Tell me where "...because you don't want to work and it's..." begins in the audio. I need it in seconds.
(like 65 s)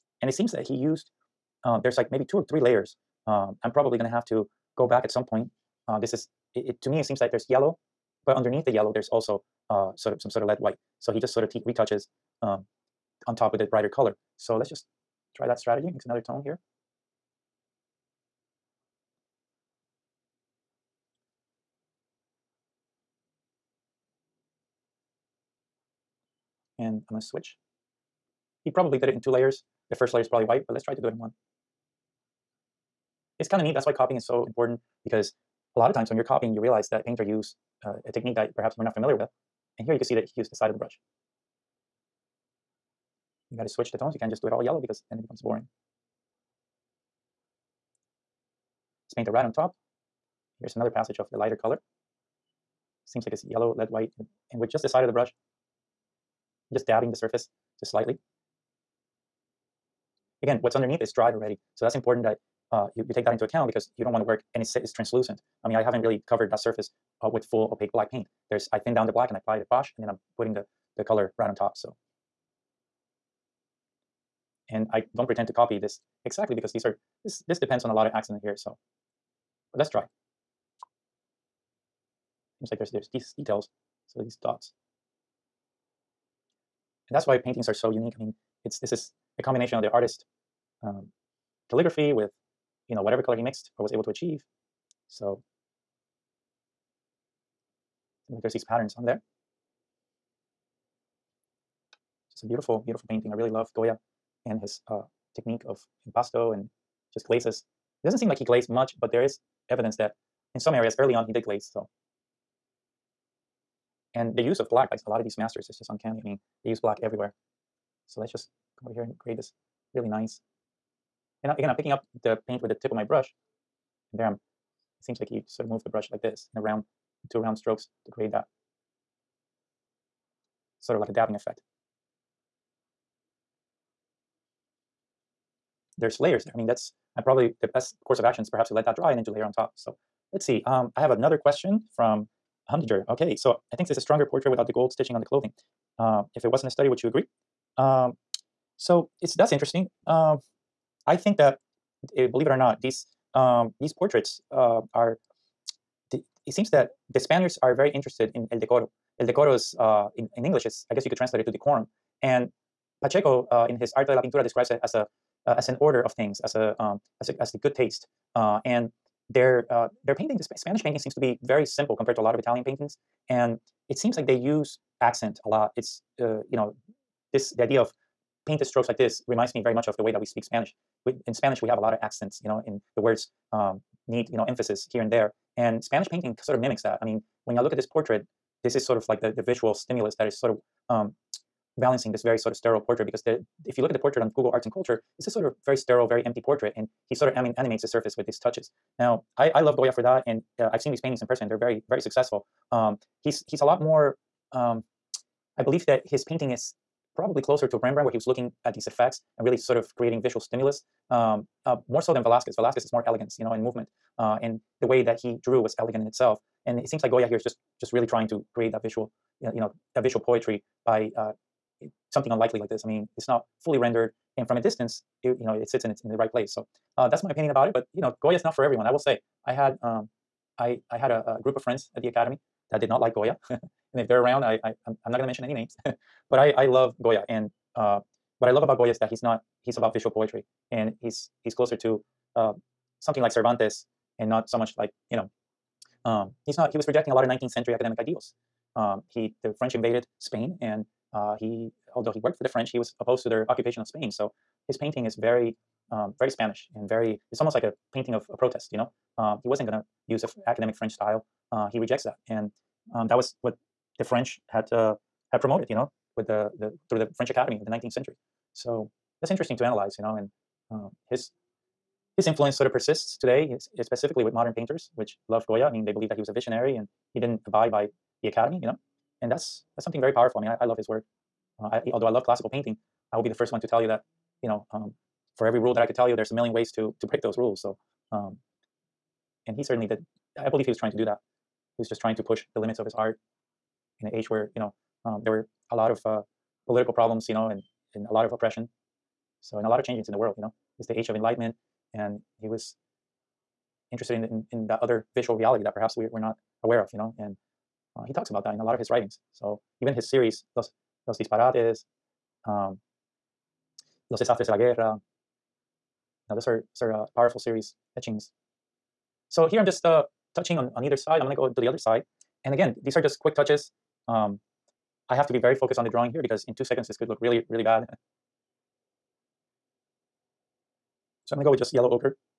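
63 s.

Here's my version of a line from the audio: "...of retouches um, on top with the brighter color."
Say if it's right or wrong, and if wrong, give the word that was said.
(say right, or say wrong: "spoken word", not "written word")
right.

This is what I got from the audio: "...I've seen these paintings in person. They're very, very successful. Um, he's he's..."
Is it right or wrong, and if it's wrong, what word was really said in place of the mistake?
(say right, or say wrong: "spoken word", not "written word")
right.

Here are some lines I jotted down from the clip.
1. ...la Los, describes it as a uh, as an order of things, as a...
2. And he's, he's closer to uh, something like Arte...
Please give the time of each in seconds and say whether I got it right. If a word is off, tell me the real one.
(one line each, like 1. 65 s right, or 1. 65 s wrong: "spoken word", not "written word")
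1. 164 s wrong: "Pintura", not "Los"
2. 240 s wrong: "Cervantes", not "Arte".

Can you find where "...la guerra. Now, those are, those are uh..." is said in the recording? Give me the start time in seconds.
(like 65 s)
314 s.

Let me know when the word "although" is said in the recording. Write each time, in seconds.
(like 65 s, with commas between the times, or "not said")
251 s, 281 s.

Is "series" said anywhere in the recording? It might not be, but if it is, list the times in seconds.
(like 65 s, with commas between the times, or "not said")
310 s, 317 s.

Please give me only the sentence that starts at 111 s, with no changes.
So, and the use of black, by a lot of these masters, is just uncanny.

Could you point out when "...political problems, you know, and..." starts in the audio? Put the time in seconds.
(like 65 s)
296 s.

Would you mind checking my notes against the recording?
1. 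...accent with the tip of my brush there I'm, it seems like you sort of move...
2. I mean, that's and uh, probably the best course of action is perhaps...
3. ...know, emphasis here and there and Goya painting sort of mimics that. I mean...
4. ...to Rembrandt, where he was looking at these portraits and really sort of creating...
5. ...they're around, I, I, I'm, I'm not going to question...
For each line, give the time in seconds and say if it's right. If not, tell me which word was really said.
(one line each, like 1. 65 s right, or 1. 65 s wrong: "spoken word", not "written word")
1. 122 s wrong: "paint", not "accent"
2. 136 s right
3. 184 s wrong: "Spanish", not "Goya"
4. 207 s wrong: "effects", not "portraits"
5. 234 s wrong: "mention", not "question".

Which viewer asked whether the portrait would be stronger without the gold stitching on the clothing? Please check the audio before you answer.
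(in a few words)
Humdinger.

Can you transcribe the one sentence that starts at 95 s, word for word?
So like there's these patterns on there.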